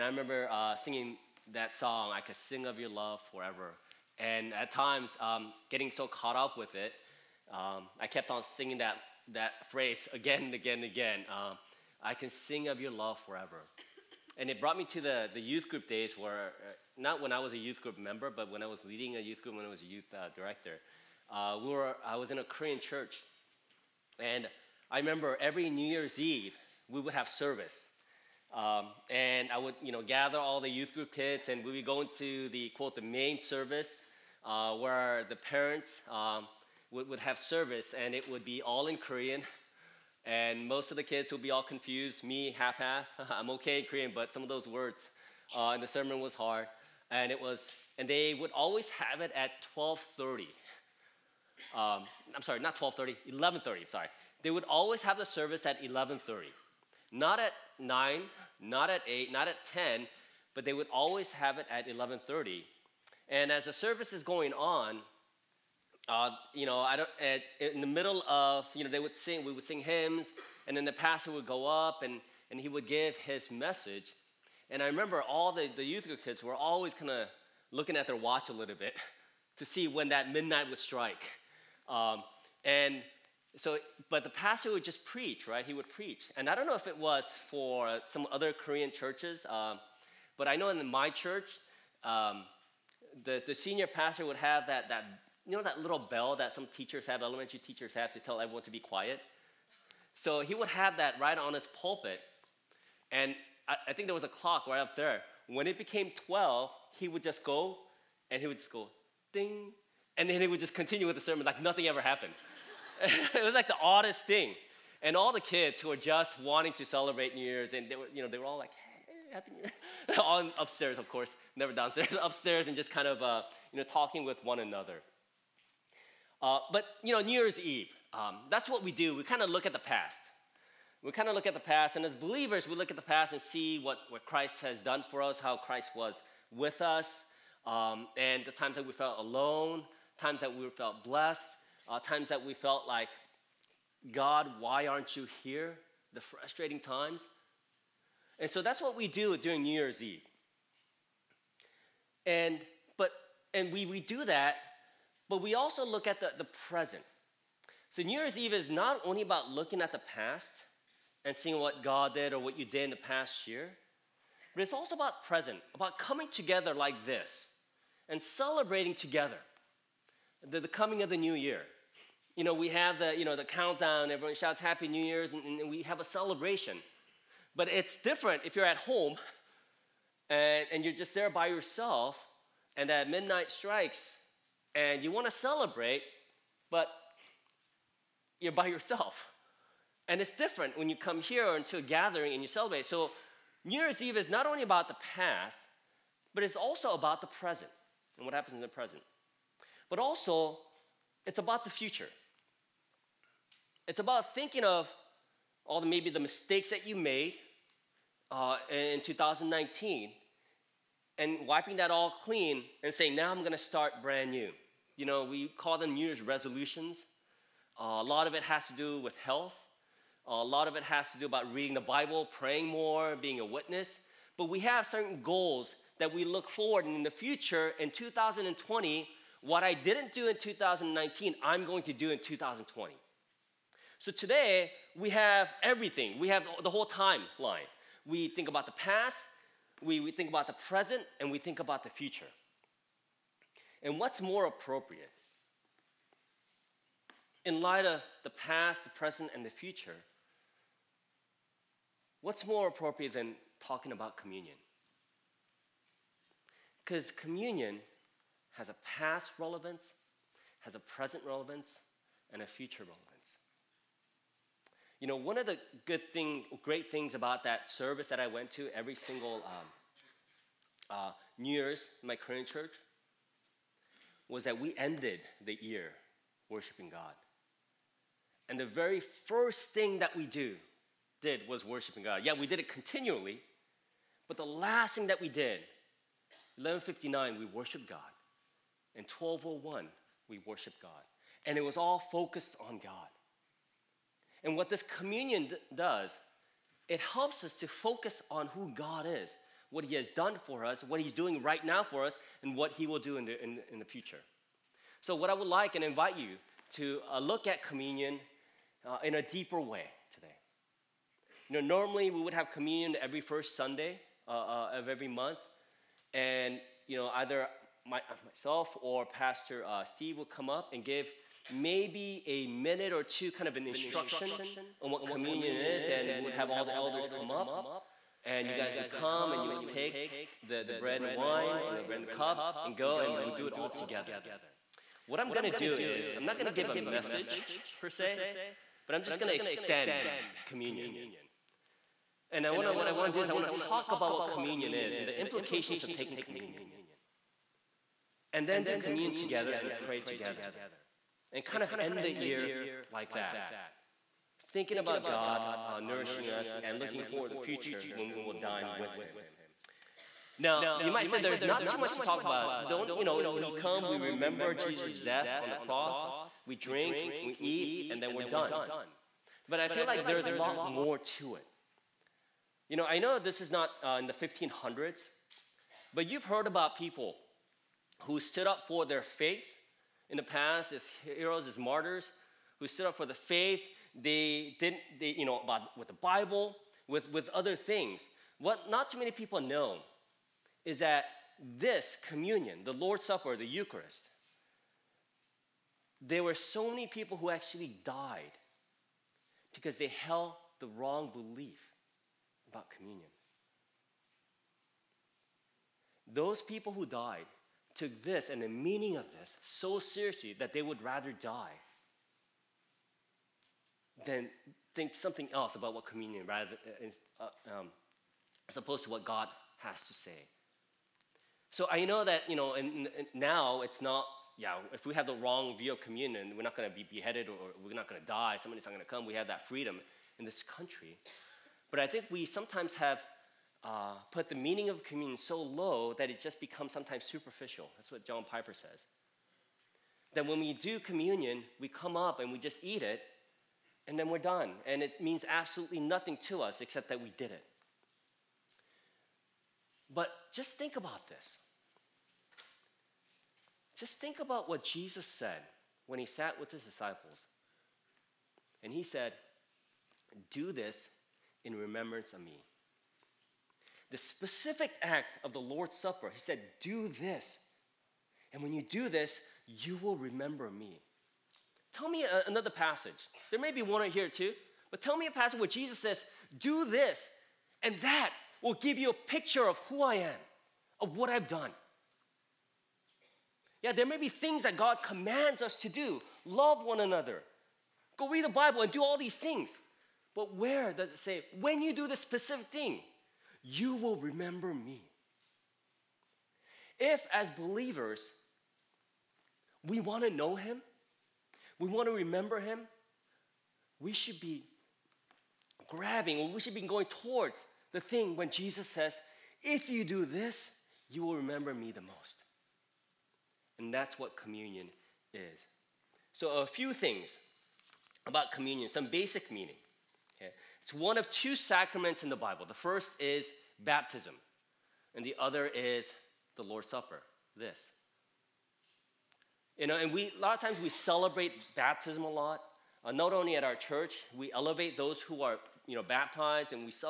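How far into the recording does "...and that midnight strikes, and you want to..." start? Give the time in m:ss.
3:02.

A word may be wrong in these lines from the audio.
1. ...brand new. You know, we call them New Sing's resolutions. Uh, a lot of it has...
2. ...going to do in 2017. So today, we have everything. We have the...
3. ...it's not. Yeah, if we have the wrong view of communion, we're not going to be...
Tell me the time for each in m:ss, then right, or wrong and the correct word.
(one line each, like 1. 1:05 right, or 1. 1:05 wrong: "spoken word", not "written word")
1. 3:34 wrong: "Year", not "Sing"
2. 3:51 wrong: "2020", not "2017"
3. 7:03 right.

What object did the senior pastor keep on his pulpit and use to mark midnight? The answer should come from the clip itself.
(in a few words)
little bell.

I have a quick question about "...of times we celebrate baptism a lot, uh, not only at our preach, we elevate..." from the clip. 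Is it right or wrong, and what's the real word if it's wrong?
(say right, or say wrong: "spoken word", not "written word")
wrong: "church", not "preach".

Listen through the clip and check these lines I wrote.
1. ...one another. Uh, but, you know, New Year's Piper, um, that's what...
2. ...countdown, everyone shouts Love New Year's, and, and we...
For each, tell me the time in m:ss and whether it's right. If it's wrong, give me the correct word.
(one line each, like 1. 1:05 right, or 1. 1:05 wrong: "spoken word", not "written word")
1. 2:04 wrong: "Eve", not "Piper"
2. 2:53 wrong: "Happy", not "Love".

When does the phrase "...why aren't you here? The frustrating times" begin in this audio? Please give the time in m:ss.
2:24.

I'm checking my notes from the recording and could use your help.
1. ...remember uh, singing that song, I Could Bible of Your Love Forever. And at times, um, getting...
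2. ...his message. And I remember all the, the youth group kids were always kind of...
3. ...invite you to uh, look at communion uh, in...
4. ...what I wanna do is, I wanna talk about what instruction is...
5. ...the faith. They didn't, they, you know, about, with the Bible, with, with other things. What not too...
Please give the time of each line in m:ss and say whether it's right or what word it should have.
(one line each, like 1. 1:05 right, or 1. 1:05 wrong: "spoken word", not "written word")
1. 0:00 wrong: "Sing", not "Bible"
2. 1:13 right
3. 5:05 right
4. 5:42 wrong: "communion", not "instruction"
5. 6:23 right.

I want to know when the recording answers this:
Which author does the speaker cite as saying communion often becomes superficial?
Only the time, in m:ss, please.
7:18.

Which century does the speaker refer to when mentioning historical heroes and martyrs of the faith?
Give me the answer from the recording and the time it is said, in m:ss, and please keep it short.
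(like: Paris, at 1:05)
1500s, at 6:14.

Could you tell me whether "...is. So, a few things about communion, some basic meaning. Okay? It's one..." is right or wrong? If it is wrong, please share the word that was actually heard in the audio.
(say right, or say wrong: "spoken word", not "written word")
right.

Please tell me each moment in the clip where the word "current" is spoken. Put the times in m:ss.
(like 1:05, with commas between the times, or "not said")
4:32.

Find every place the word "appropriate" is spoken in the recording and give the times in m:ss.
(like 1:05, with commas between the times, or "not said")
4:04, 4:12.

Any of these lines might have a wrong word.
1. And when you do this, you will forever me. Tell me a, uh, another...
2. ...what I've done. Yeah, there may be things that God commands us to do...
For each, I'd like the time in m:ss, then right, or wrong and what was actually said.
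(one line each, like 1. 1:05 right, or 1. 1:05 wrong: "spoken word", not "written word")
1. 7:48 wrong: "remember", not "forever"
2. 8:00 right.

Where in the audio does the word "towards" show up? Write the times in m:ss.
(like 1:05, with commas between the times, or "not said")
8:26.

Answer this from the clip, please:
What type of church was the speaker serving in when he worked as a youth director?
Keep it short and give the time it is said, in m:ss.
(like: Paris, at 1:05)
Korean church, at 0:22.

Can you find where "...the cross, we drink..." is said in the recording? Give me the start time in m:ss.
6:05.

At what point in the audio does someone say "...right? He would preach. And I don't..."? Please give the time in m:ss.
1:25.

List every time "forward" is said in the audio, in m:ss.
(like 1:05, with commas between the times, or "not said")
3:46, 5:57.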